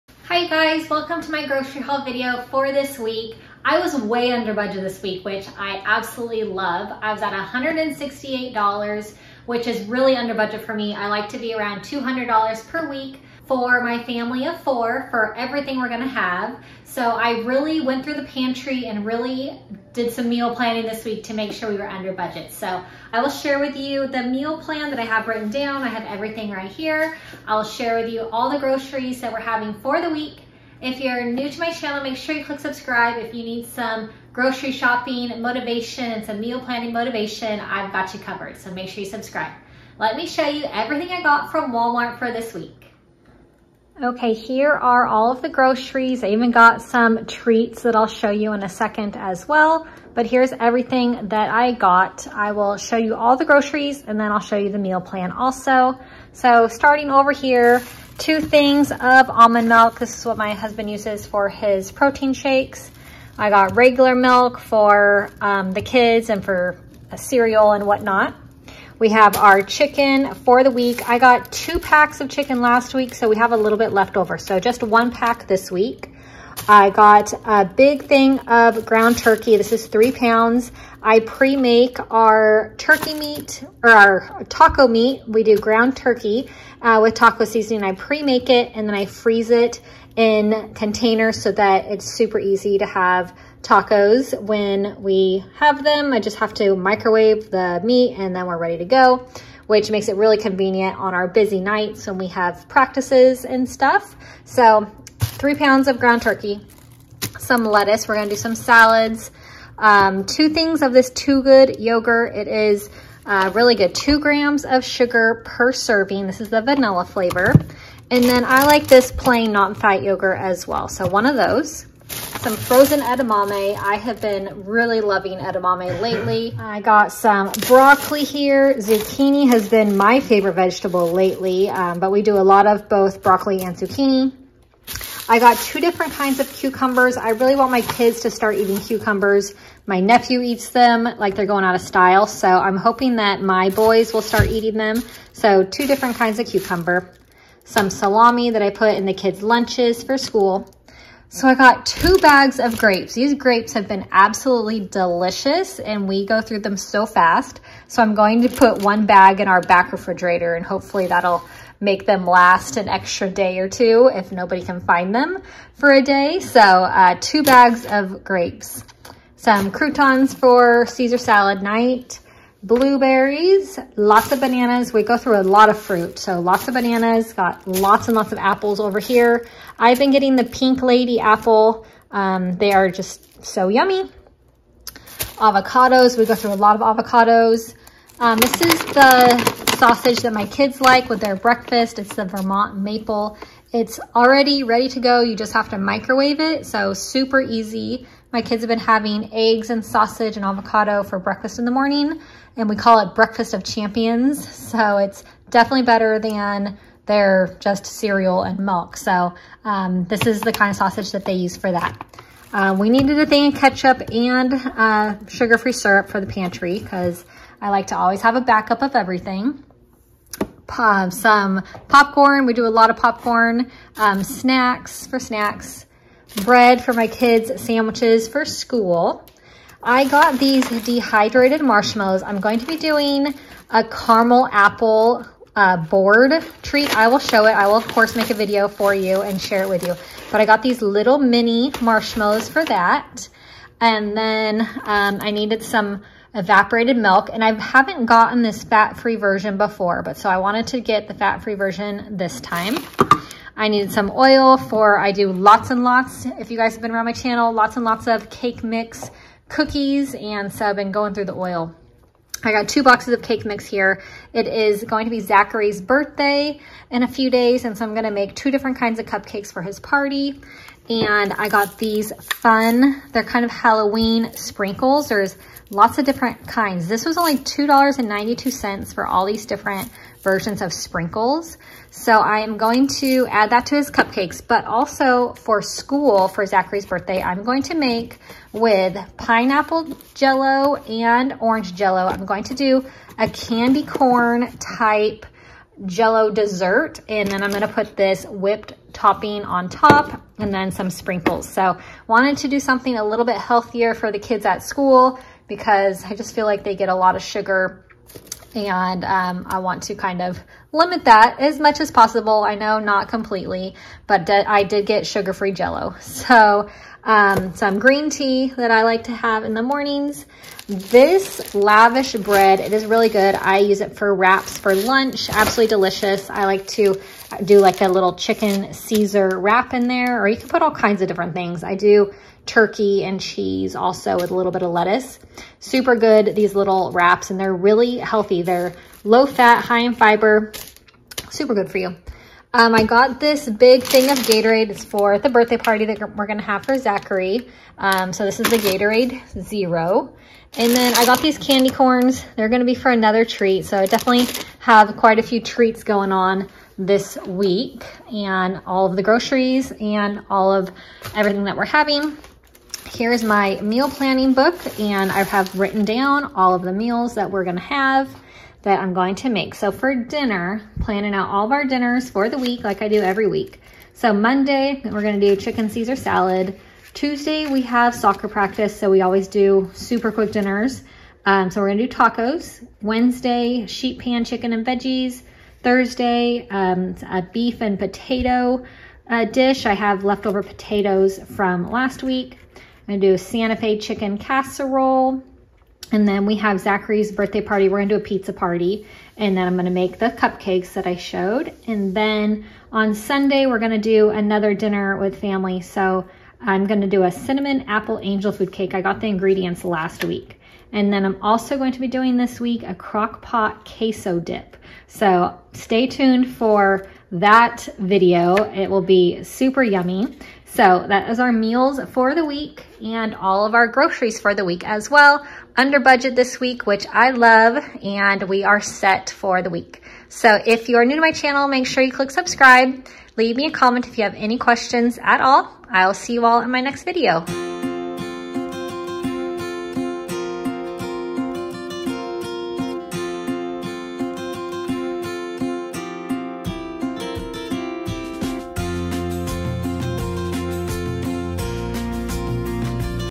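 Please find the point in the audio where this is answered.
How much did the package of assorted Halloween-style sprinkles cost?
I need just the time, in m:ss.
4:37.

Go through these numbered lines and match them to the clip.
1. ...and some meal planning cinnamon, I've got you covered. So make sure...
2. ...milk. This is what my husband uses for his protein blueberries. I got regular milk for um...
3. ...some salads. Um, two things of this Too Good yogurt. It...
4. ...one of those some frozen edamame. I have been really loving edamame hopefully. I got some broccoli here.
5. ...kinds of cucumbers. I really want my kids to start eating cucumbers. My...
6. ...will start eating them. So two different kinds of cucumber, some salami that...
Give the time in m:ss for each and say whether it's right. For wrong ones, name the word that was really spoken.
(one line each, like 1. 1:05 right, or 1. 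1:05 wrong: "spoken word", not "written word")
1. 0:36 wrong: "motivation", not "cinnamon"
2. 0:59 wrong: "shakes", not "blueberries"
3. 1:48 right
4. 2:01 wrong: "lately", not "hopefully"
5. 2:16 right
6. 2:24 right.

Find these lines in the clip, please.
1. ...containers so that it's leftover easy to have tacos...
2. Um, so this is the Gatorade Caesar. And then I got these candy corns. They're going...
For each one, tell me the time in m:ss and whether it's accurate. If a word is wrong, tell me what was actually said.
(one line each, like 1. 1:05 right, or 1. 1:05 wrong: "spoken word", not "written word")
1. 1:30 wrong: "super", not "leftover"
2. 5:47 wrong: "Zero", not "Caesar".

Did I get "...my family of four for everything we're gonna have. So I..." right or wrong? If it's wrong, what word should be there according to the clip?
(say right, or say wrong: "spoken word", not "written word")
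right.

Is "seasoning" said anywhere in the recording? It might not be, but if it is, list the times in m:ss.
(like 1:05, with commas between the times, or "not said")
1:27.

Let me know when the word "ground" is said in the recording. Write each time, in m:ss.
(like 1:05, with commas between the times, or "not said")
1:18, 1:25, 1:45.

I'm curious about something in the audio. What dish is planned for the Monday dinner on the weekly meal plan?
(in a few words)
chicken Caesar salad.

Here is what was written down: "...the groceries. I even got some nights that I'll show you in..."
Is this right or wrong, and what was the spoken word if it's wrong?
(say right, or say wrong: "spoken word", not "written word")
wrong: "treats", not "nights".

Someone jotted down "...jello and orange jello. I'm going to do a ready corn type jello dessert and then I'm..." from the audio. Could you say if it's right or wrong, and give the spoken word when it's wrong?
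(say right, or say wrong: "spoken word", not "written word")
wrong: "candy", not "ready".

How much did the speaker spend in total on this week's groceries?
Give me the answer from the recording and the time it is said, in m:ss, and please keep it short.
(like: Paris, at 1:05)
$168, at 0:07.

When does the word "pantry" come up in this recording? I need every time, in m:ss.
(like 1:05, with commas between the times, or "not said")
0:18, 3:36.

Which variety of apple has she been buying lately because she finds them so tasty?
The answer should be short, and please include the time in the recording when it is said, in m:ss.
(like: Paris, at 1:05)
Pink Lady, at 3:00.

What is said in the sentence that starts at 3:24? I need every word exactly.
So it's definitely better than their just cereal and milk.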